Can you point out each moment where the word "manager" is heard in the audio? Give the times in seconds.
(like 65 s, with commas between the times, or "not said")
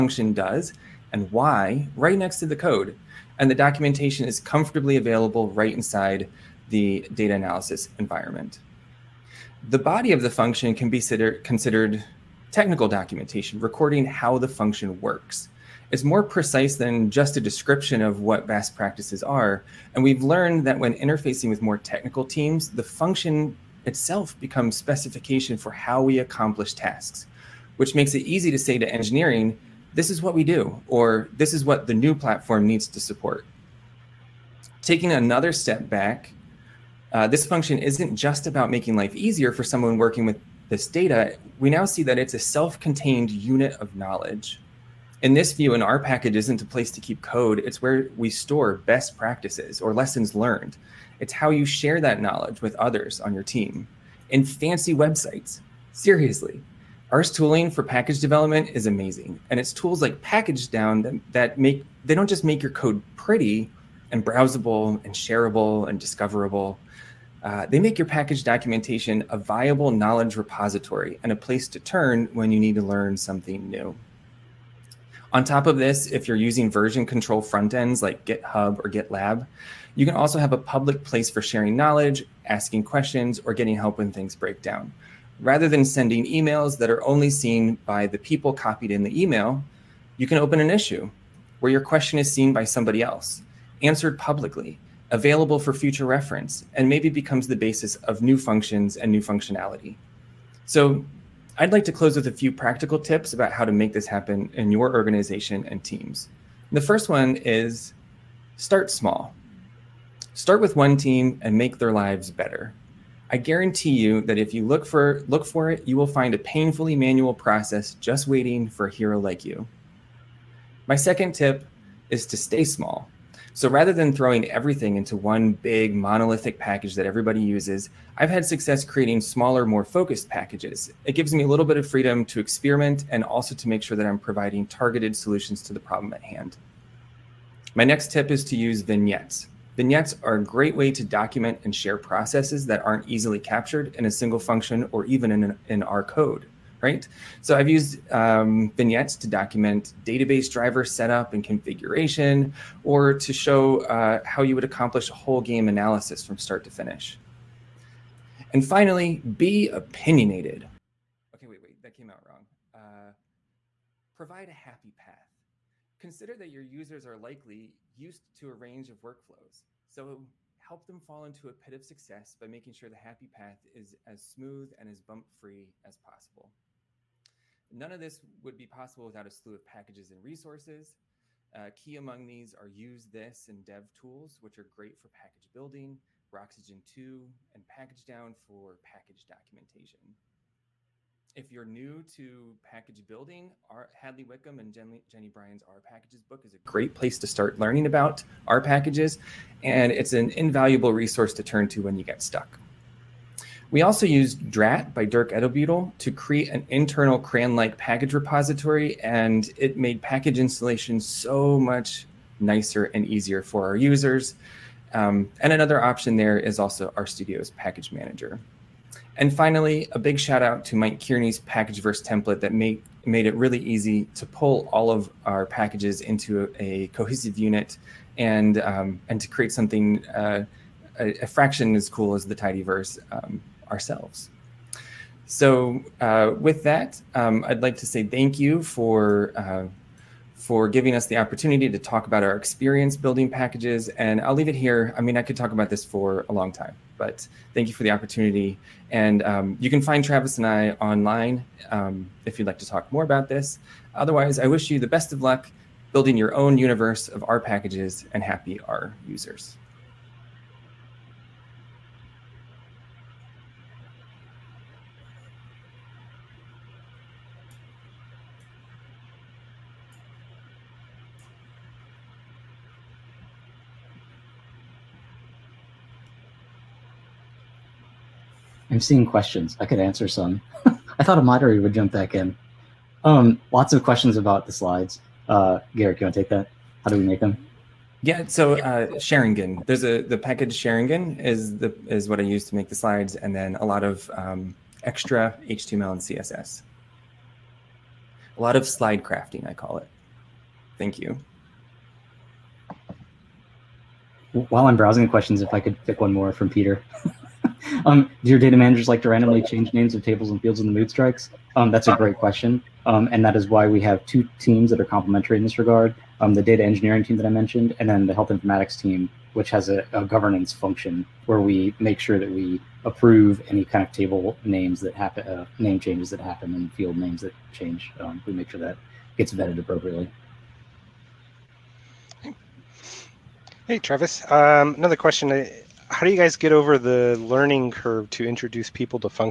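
217 s, 308 s.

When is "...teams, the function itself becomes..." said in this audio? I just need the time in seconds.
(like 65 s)
22 s.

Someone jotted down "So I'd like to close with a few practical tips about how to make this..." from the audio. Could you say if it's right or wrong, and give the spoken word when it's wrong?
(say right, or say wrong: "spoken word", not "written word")
right.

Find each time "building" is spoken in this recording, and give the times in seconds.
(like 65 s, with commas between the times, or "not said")
185 s, 193 s, 242 s, 255 s.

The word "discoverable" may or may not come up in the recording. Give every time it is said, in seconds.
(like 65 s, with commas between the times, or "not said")
65 s.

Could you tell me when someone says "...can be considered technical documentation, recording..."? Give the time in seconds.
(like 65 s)
10 s.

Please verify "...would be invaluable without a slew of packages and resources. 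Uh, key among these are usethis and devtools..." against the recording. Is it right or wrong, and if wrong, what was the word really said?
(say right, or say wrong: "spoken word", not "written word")
wrong: "possible", not "invaluable".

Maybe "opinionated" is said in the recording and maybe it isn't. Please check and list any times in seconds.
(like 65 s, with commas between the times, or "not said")
159 s.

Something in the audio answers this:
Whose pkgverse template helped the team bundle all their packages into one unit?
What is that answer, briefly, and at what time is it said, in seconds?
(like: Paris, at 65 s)
Mike Kearney, at 220 s.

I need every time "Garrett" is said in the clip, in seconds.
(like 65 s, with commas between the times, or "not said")
285 s.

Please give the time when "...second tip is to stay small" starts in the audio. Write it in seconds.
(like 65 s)
120 s.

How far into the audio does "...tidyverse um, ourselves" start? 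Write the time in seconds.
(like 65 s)
232 s.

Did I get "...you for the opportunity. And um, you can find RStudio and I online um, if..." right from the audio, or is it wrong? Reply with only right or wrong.
wrong.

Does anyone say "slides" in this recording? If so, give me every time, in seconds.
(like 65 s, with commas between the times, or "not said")
284 s, 292 s, 298 s.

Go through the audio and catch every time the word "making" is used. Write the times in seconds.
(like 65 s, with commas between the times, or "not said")
38 s, 172 s.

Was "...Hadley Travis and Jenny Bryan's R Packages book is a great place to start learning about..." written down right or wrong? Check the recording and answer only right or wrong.
wrong.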